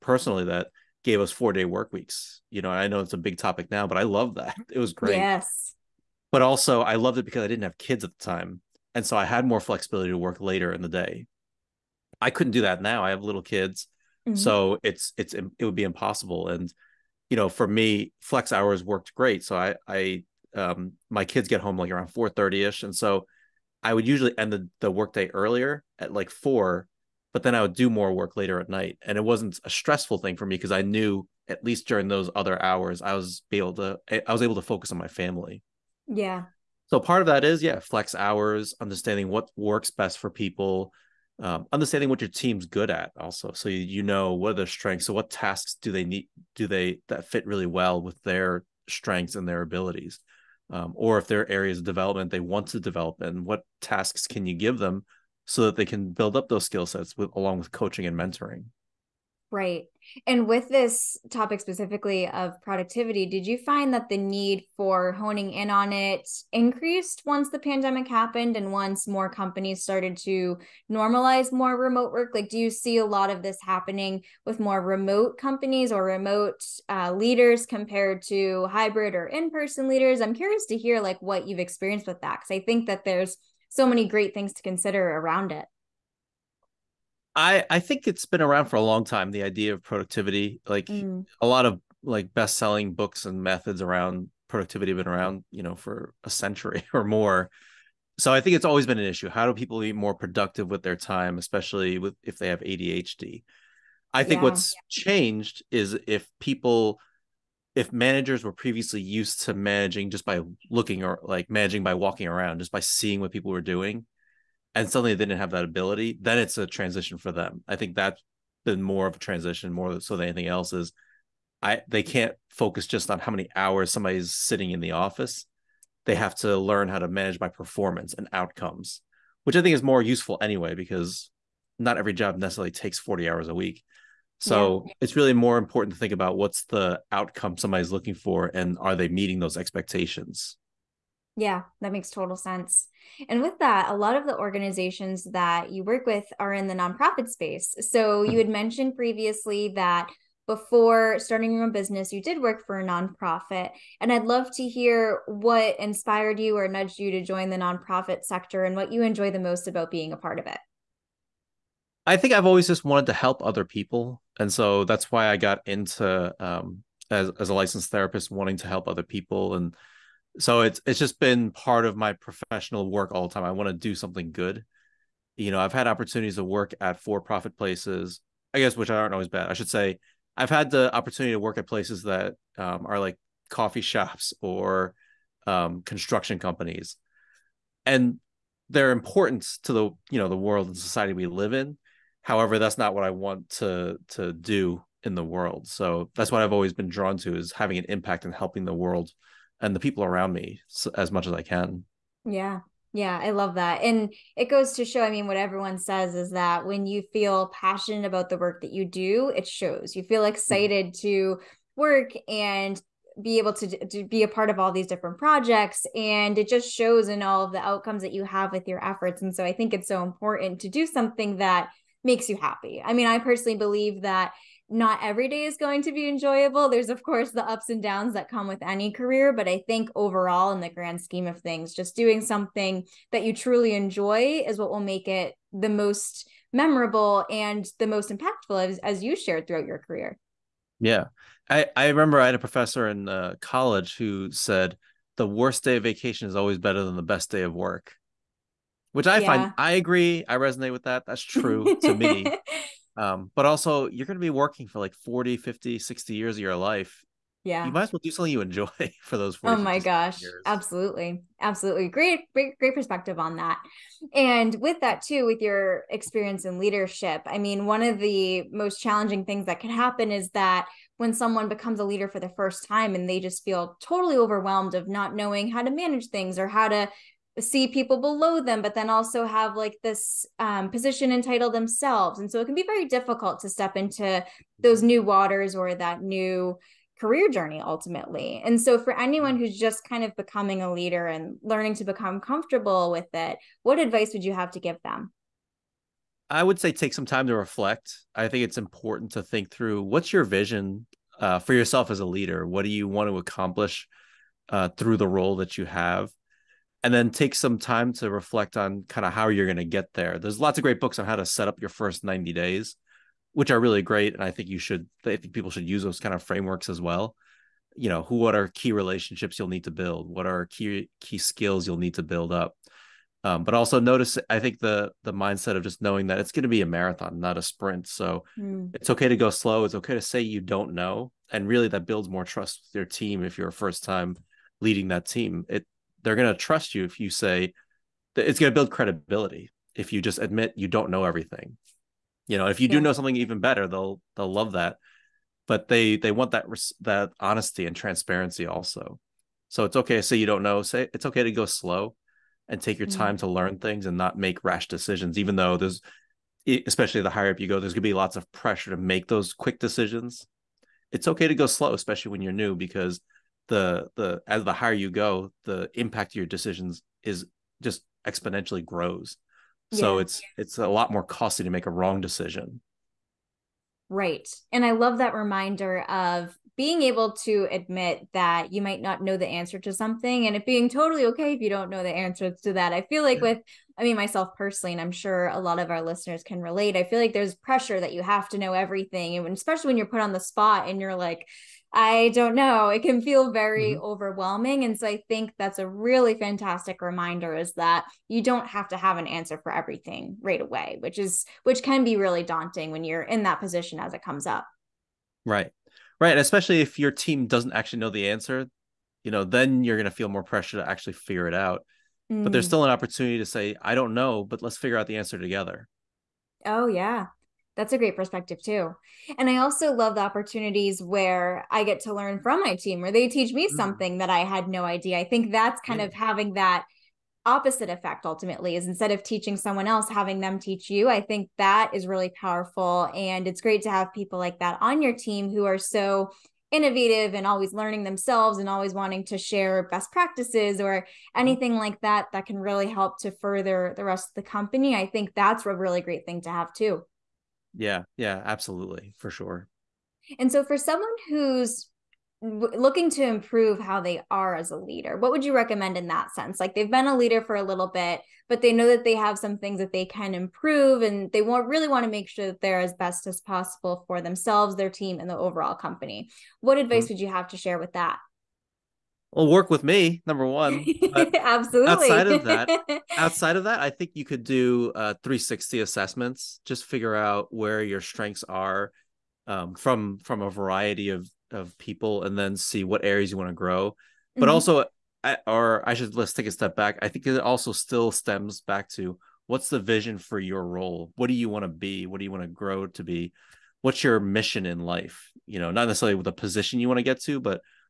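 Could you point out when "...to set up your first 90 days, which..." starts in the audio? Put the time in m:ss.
5:11.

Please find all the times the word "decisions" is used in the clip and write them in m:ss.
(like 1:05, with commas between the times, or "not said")
5:54, 5:59, 6:06, 6:11.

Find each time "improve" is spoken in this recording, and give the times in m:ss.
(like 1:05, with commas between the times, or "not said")
7:33, 7:40.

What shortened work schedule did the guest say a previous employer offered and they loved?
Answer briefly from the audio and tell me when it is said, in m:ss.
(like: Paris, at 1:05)
four day work weeks, at 0:01.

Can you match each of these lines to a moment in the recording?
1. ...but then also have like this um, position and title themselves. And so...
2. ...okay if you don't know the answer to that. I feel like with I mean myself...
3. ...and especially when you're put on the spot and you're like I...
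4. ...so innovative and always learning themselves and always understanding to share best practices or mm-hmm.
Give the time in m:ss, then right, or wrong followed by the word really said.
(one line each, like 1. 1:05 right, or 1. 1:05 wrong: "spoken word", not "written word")
1. 4:38 right
2. 6:21 right
3. 6:29 right
4. 7:15 wrong: "wanting", not "understanding".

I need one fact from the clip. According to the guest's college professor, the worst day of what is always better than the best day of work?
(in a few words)
vacation.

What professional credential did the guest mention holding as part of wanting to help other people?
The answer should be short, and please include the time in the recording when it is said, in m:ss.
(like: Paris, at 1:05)
licensed therapist, at 2:47.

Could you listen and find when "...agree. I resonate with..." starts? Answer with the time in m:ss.
4:09.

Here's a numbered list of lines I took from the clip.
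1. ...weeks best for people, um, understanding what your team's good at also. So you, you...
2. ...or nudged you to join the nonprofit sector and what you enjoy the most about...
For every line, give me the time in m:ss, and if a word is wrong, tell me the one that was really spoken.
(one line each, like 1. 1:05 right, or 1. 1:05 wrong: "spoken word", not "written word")
1. 0:39 wrong: "works", not "weeks"
2. 2:36 right.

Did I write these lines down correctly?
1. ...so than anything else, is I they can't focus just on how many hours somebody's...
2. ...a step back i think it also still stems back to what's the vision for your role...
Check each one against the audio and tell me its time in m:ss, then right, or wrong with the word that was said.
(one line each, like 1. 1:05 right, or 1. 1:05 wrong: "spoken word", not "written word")
1. 1:59 right
2. 8:06 right.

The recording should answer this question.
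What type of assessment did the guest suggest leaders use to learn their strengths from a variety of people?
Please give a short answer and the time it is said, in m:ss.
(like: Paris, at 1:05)
360 assessments, at 7:55.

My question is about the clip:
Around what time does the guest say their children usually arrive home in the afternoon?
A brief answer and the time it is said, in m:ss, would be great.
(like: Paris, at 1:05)
4:30, at 0:22.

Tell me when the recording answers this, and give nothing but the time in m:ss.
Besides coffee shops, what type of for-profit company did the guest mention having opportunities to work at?
3:05.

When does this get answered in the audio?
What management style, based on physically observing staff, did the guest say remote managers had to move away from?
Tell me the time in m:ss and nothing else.
1:51.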